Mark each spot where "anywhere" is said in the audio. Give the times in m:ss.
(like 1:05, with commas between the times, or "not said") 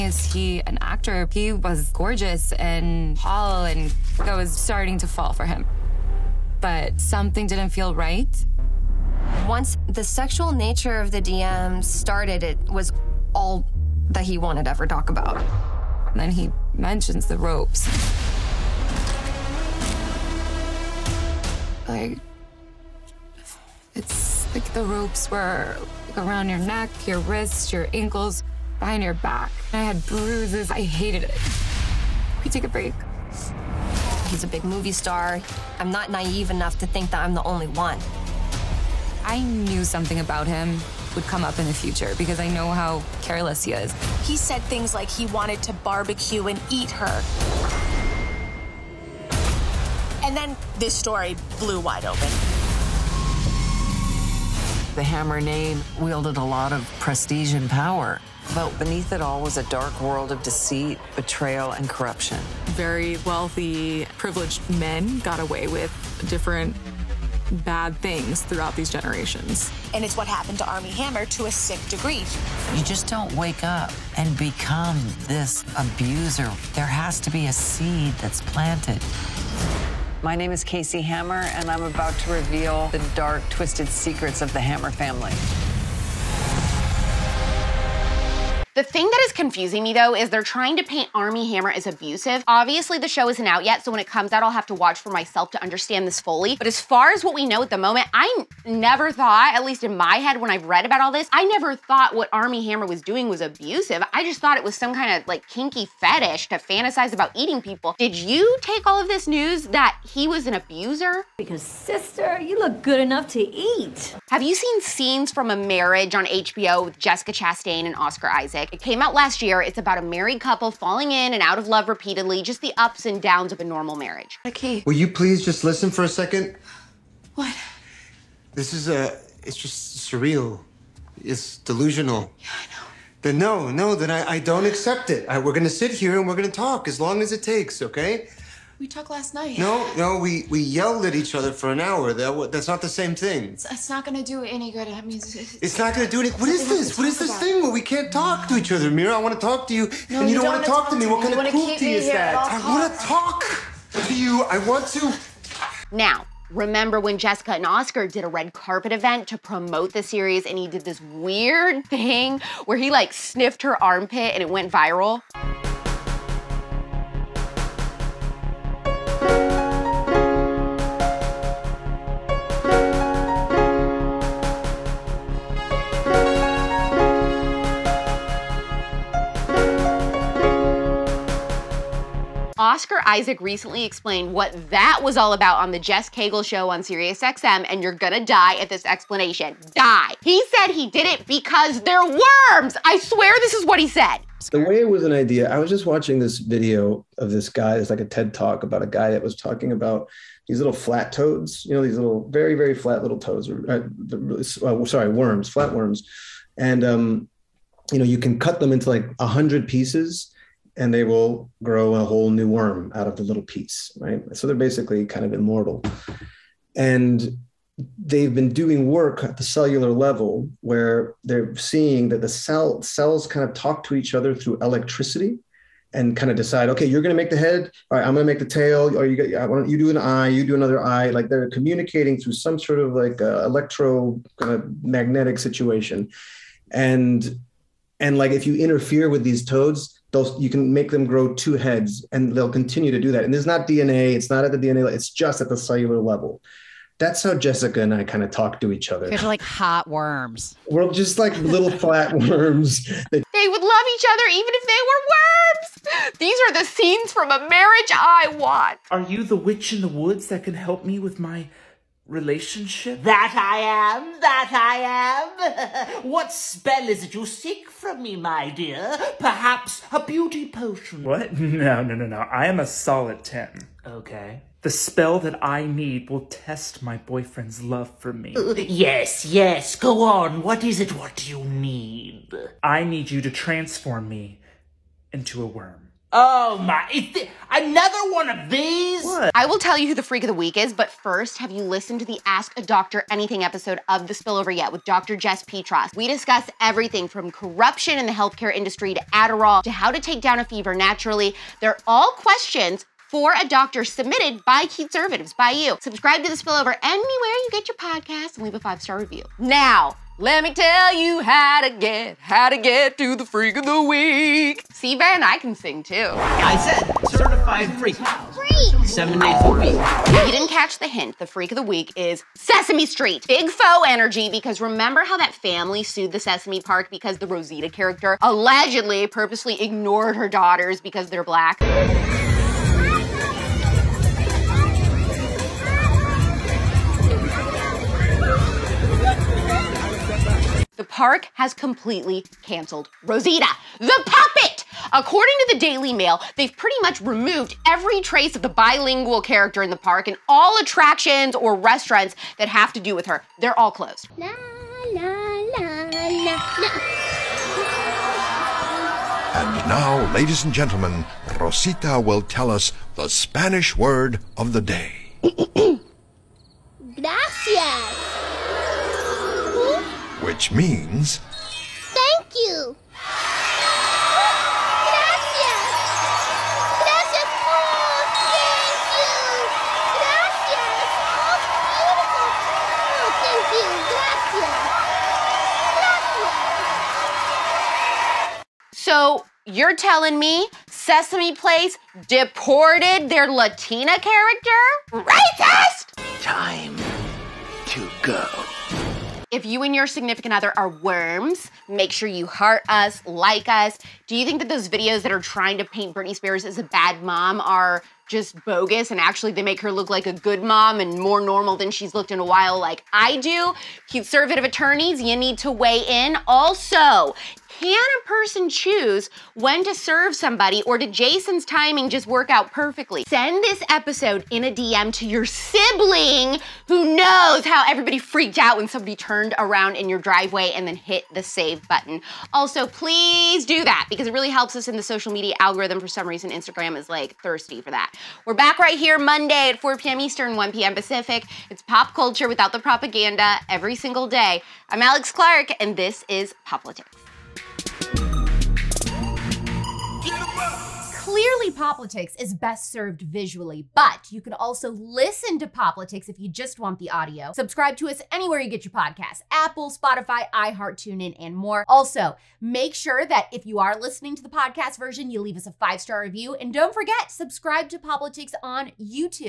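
5:06, 7:38.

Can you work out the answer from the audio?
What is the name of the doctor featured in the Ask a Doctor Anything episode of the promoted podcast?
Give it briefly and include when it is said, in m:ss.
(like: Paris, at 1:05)
Dr. Jess Petros, at 4:54.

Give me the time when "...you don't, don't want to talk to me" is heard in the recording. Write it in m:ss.
2:30.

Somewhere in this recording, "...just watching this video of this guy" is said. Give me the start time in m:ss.
3:15.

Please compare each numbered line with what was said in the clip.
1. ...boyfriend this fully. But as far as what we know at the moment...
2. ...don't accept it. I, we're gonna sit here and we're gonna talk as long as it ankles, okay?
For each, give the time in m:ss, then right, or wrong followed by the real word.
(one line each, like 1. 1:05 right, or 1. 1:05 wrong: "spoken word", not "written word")
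1. 1:35 wrong: "understand", not "boyfriend"
2. 2:14 wrong: "takes", not "ankles".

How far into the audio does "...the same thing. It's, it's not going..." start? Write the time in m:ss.
2:22.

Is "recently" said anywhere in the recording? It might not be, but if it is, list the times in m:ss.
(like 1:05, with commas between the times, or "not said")
3:03.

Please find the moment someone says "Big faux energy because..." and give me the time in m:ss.
5:23.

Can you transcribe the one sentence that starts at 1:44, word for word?
I just thought it was some kind of like kinky fetish to fantasize about eating people.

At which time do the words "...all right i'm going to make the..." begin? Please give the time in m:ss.
3:47.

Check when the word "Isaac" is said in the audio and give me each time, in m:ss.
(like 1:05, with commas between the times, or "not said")
1:58, 3:03.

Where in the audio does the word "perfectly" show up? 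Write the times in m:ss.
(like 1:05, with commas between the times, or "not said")
7:02.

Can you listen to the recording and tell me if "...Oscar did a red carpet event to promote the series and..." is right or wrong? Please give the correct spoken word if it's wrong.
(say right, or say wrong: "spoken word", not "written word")
right.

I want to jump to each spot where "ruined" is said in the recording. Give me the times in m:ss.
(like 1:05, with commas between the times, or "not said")
not said.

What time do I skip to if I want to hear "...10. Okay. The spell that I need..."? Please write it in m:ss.
4:33.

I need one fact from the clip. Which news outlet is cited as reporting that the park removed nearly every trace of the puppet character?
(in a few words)
Daily Mail.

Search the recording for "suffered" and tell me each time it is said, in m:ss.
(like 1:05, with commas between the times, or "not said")
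not said.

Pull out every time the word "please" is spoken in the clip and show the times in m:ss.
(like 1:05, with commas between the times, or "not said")
2:05, 7:12.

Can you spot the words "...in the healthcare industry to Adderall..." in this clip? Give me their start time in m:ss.
4:57.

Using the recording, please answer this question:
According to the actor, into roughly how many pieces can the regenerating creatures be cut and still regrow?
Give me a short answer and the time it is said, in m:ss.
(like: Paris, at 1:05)
100, at 3:29.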